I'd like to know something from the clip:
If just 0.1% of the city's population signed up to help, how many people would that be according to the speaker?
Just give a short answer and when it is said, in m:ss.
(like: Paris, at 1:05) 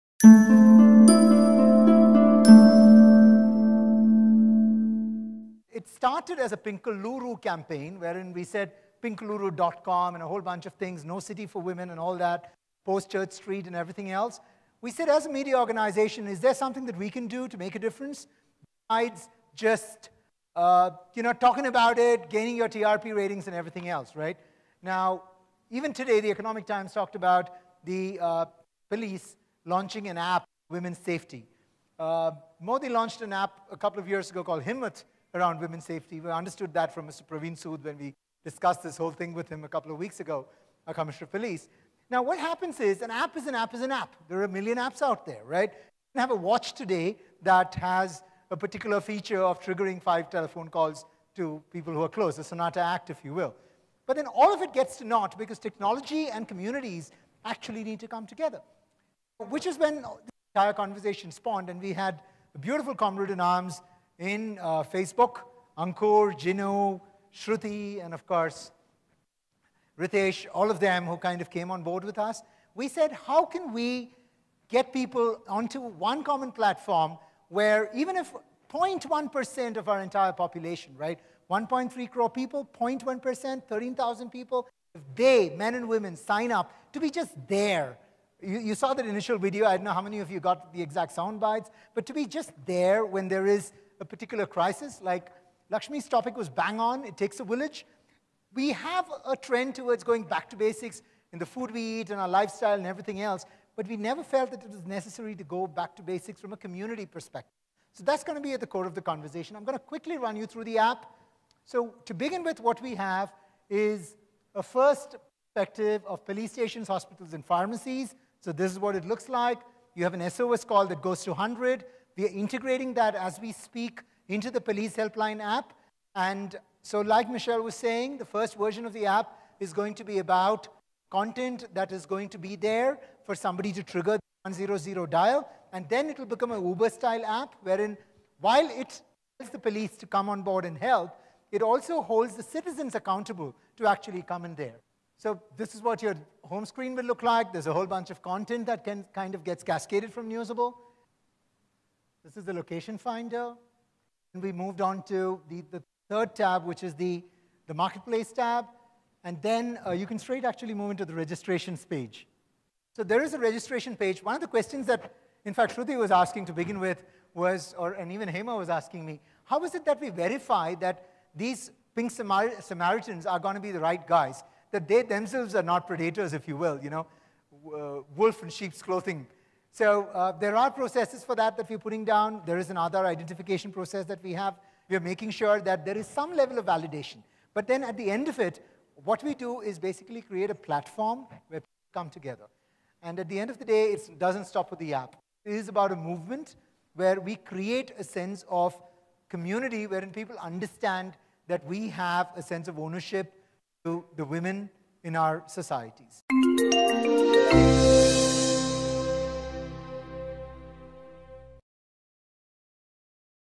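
13,000, at 1:23.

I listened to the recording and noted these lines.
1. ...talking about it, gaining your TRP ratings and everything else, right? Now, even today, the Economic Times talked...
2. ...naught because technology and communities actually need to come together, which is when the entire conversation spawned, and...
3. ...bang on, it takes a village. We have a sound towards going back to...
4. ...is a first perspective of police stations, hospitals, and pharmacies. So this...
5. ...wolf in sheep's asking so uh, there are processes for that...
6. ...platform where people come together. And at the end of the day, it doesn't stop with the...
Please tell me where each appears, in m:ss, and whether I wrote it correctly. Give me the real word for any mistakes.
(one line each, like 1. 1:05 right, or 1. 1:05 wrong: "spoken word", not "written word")
1. 0:21 right
2. 0:55 right
3. 1:36 wrong: "trend", not "sound"
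4. 1:53 right
5. 2:58 wrong: "clothing", not "asking"
6. 3:10 right.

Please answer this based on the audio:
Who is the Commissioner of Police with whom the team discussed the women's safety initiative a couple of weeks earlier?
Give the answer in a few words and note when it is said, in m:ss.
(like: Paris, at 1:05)
Praveen Sood, at 0:37.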